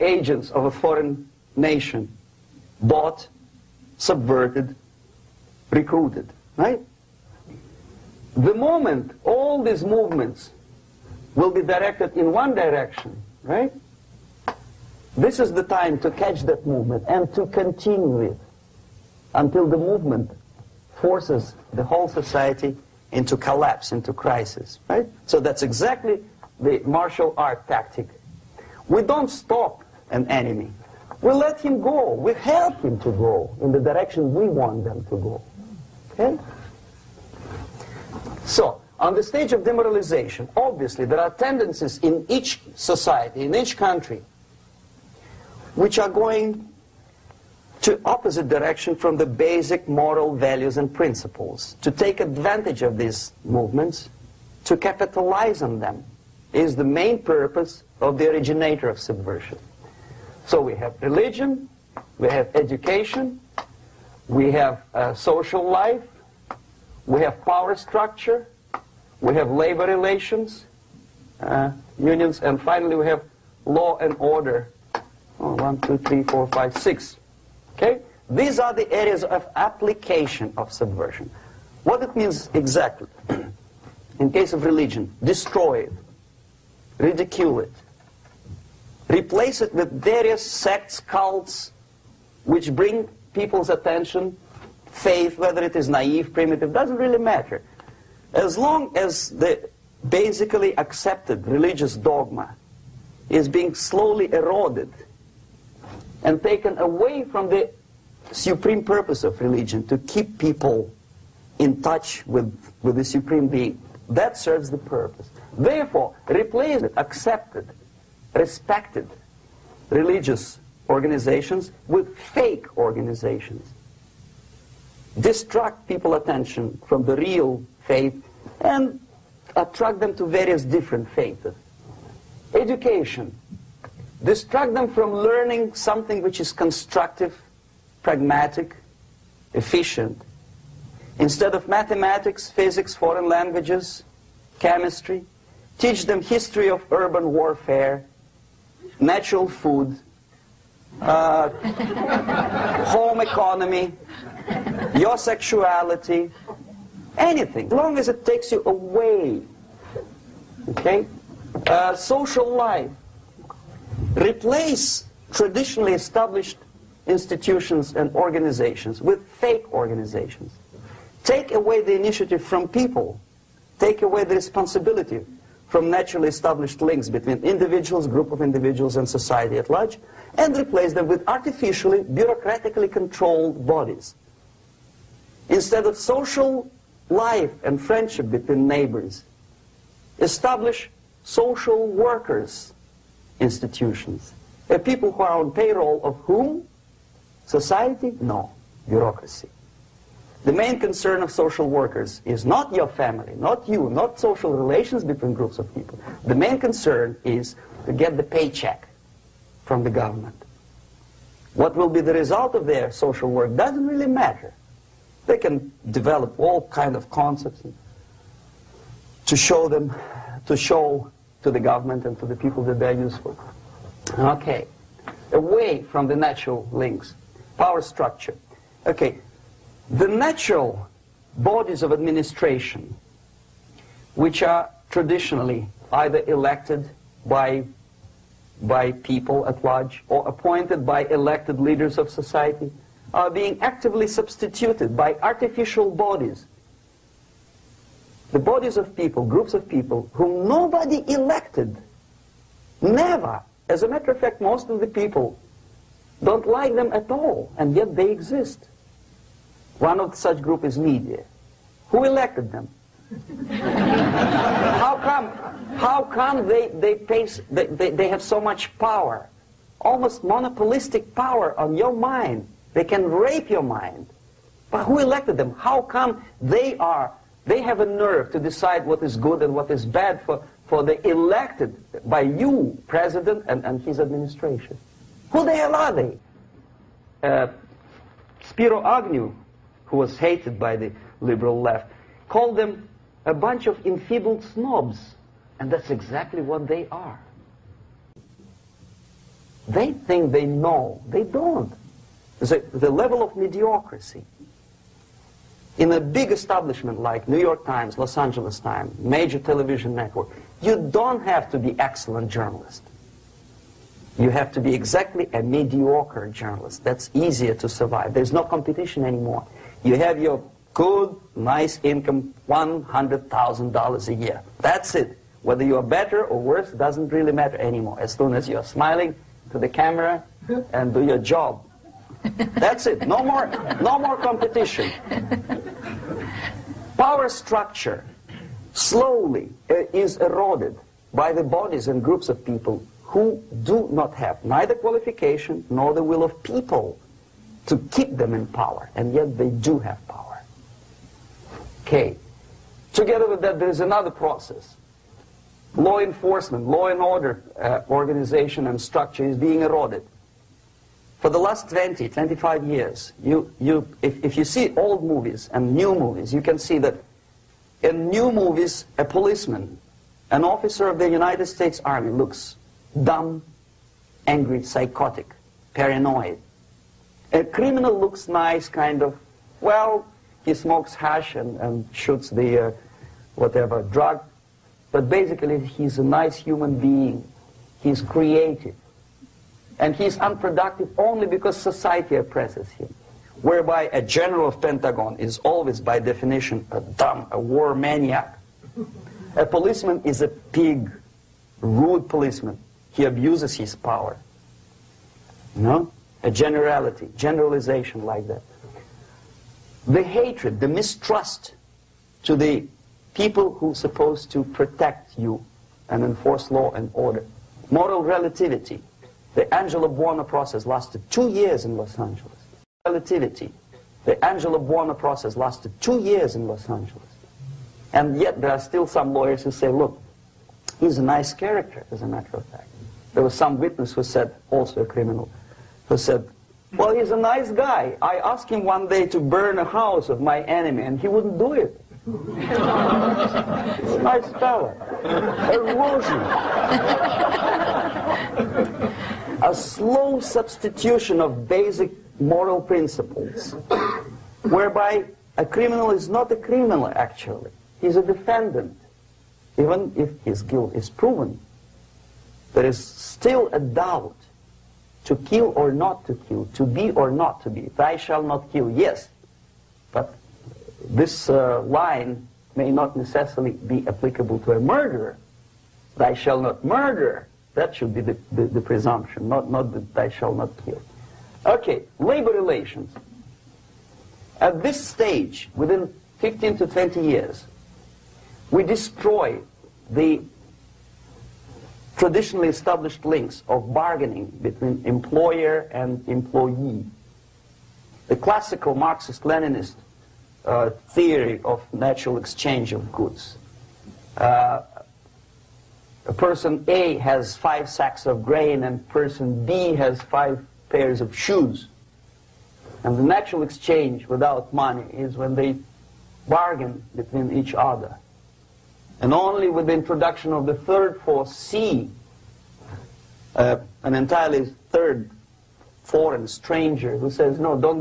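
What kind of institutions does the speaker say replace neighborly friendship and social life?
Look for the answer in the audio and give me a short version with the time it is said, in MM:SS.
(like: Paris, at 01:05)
social workers institutions, at 03:11.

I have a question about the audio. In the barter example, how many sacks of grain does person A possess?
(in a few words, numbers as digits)
5.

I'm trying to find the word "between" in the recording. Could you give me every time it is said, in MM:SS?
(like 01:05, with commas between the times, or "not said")
02:57, 03:08, 03:25, 08:14, 08:36.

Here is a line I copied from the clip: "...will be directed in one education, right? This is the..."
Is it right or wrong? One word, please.
wrong.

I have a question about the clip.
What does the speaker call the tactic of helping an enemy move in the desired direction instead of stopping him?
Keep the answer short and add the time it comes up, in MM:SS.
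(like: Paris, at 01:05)
martial art tactic, at 00:26.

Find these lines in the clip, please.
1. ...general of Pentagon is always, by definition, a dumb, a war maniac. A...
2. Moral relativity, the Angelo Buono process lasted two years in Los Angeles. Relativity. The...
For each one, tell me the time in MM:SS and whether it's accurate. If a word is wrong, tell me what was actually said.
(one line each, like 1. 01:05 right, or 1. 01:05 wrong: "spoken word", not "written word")
1. 06:33 right
2. 06:57 right.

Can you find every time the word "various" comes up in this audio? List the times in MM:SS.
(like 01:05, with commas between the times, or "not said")
01:29, 02:10.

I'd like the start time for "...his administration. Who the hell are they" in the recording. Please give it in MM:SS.
04:43.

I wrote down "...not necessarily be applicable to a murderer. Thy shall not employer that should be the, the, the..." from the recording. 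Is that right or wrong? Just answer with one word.
wrong.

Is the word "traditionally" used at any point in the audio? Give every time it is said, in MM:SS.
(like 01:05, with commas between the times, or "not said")
02:45, 03:54, 08:11.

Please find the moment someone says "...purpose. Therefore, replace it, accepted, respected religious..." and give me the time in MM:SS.
01:54.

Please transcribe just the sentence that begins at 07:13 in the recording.
There was some witness who said, also a criminal, who said, well, he's a nice guy.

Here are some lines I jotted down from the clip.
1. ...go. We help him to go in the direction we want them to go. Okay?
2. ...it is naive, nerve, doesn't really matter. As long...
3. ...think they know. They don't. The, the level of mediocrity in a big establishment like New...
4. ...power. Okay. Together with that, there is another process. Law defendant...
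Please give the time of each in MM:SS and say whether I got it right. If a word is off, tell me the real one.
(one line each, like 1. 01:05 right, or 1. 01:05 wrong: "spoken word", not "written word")
1. 00:31 right
2. 01:35 wrong: "primitive", not "nerve"
3. 04:59 right
4. 05:50 wrong: "enforcement", not "defendant".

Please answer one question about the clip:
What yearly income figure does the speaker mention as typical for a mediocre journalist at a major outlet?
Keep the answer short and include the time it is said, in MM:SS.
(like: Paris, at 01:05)
$100,000, at 05:22.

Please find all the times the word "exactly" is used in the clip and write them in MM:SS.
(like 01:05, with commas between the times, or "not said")
00:25, 01:22, 04:55, 05:14.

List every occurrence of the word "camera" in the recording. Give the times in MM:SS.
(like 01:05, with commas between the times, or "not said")
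05:29.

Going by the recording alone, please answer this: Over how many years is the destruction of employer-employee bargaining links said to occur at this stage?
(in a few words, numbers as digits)
15 to 20 years.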